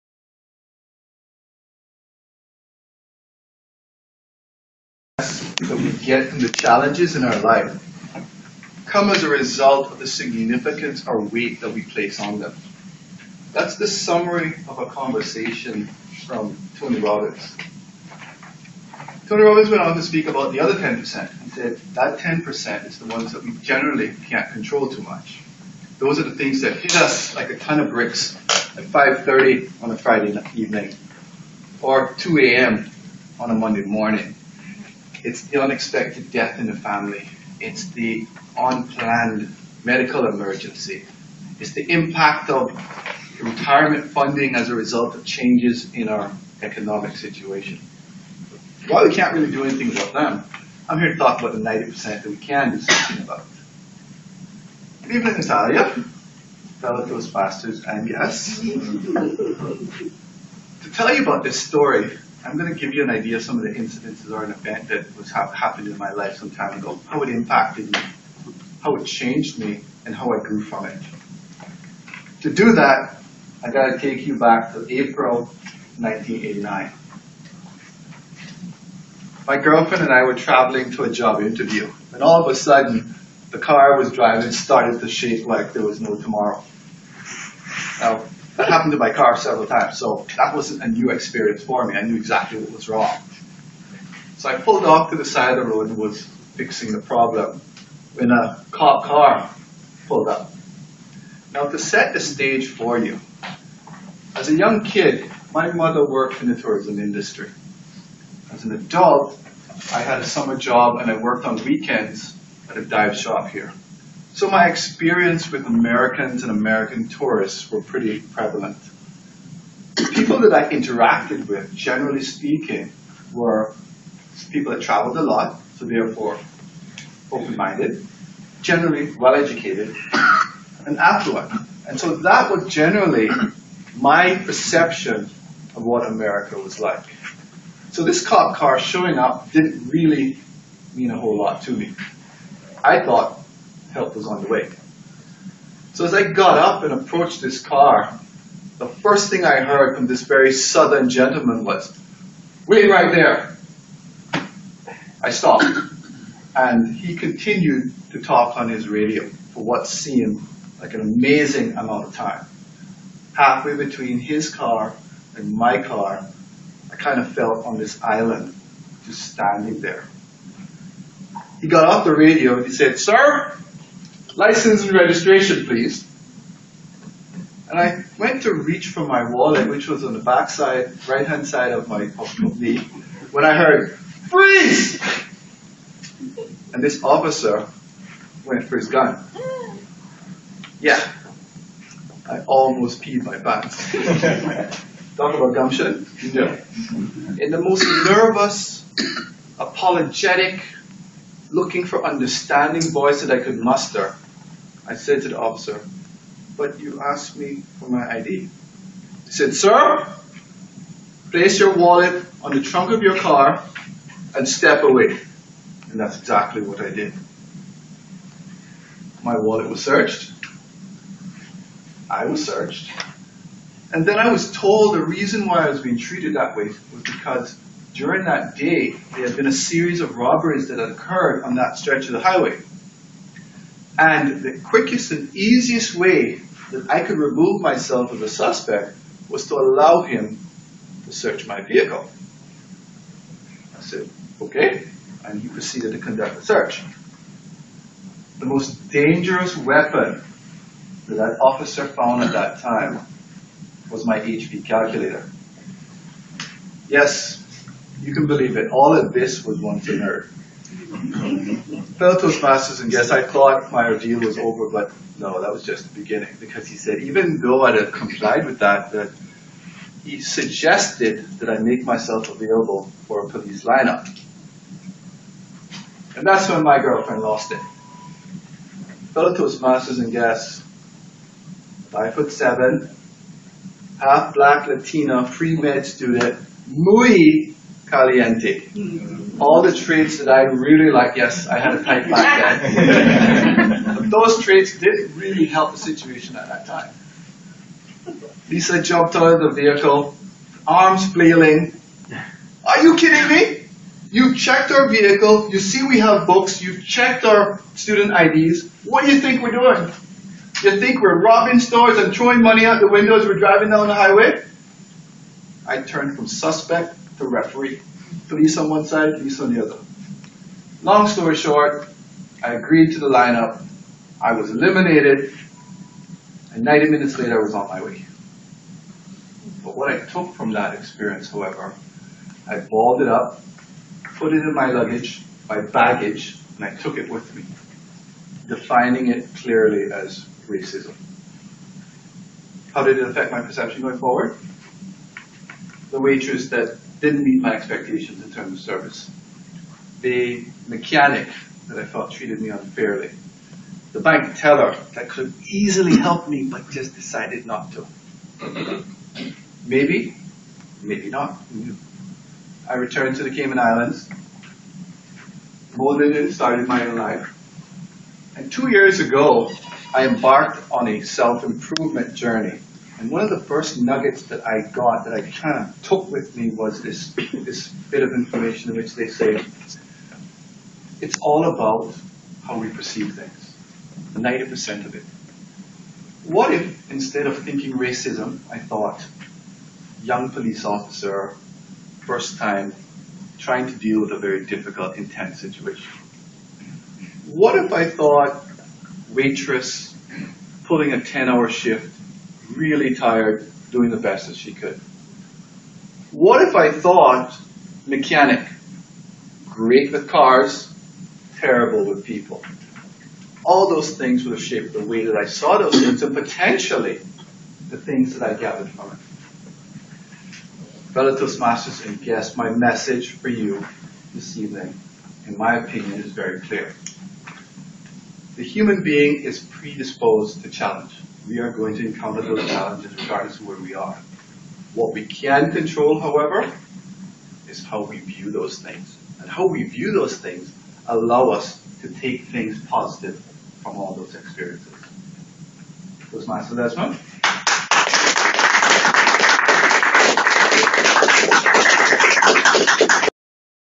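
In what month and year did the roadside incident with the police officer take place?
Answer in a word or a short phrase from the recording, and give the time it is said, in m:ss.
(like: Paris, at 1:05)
April 1989, at 1:14.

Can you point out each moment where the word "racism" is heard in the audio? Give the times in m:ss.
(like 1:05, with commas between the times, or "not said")
5:40, 6:27.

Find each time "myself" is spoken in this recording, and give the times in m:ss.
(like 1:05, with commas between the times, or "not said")
3:57, 4:31.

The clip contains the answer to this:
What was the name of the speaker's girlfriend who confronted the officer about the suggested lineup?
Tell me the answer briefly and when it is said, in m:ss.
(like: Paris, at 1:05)
Lisa, at 4:58.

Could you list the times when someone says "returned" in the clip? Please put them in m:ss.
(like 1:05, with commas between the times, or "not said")
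6:02.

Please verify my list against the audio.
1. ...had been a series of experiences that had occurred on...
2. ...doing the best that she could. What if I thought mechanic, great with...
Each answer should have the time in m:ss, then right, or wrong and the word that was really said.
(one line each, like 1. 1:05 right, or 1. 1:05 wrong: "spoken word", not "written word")
1. 3:49 wrong: "robberies", not "experiences"
2. 6:43 right.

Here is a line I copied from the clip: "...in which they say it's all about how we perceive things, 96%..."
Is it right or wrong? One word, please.
wrong.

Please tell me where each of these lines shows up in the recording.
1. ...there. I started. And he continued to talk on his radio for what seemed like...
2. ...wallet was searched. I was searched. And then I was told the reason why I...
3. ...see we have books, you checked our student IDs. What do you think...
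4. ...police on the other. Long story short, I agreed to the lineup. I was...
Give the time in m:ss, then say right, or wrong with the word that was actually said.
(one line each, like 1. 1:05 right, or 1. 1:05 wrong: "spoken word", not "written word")
1. 2:33 wrong: "stopped", not "started"
2. 3:39 right
3. 5:05 right
4. 5:19 right.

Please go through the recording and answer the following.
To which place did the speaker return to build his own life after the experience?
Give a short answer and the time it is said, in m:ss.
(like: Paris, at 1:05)
Cayman Islands, at 6:03.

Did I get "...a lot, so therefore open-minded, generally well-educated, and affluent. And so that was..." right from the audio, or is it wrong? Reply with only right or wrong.
right.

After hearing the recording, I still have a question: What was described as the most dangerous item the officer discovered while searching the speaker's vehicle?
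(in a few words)
HP calculator.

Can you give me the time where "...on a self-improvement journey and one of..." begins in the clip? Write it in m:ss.
6:10.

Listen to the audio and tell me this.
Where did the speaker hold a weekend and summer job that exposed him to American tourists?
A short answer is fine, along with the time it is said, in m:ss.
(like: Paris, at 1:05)
A dive shop, at 1:52.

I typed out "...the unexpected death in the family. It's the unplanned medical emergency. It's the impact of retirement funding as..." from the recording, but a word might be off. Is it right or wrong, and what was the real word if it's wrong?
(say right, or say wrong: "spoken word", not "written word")
right.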